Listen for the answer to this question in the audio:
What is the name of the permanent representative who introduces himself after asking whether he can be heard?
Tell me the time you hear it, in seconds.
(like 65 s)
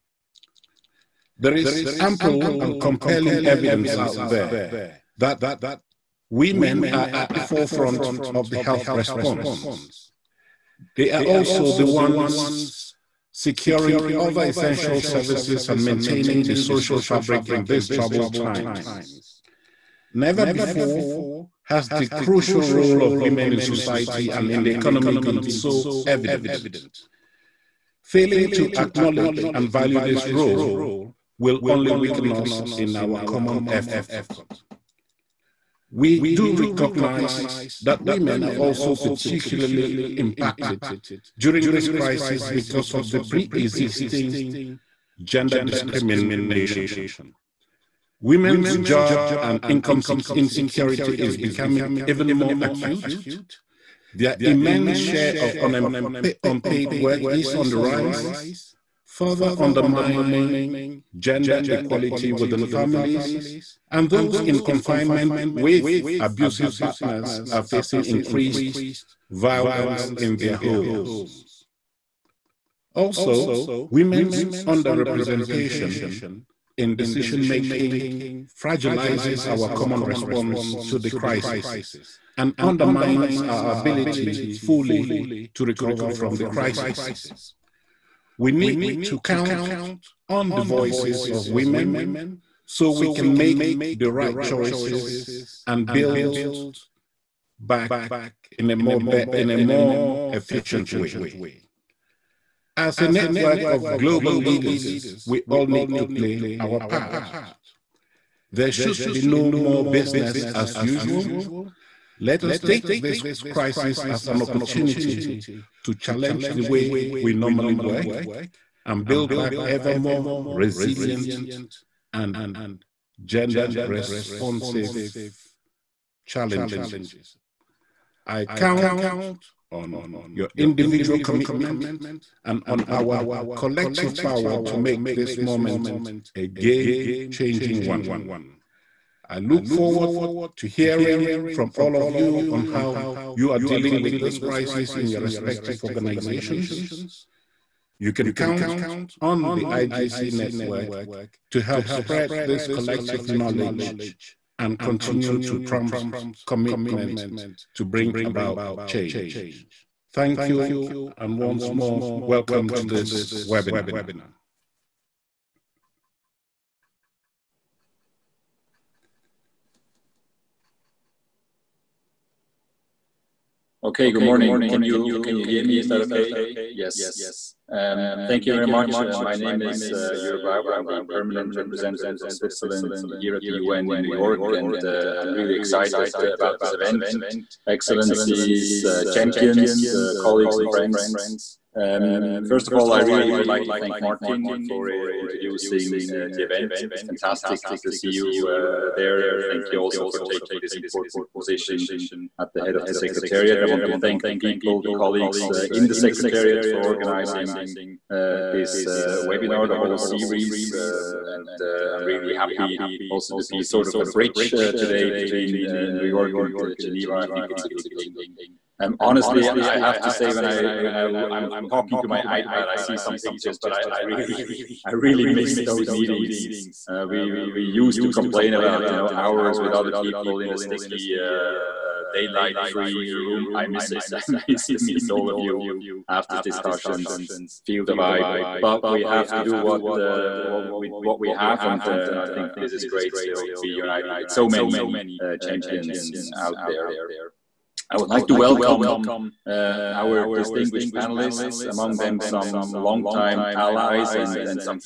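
180 s.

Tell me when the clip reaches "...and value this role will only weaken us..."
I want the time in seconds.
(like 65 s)
29 s.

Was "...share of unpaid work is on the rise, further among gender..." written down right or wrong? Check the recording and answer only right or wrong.
wrong.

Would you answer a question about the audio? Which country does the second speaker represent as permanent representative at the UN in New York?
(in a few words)
Switzerland.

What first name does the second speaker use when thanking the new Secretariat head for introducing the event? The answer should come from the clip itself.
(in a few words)
Martin.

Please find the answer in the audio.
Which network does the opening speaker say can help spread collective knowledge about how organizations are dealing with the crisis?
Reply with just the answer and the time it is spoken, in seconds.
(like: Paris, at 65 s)
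IGC network, at 149 s.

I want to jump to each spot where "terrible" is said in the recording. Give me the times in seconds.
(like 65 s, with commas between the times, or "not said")
not said.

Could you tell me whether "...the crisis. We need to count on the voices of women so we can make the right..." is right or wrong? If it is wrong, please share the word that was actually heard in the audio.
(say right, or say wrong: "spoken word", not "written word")
right.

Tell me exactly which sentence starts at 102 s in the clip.
As a network of global leaders, we all need to play our part.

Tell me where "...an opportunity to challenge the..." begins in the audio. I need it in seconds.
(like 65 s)
114 s.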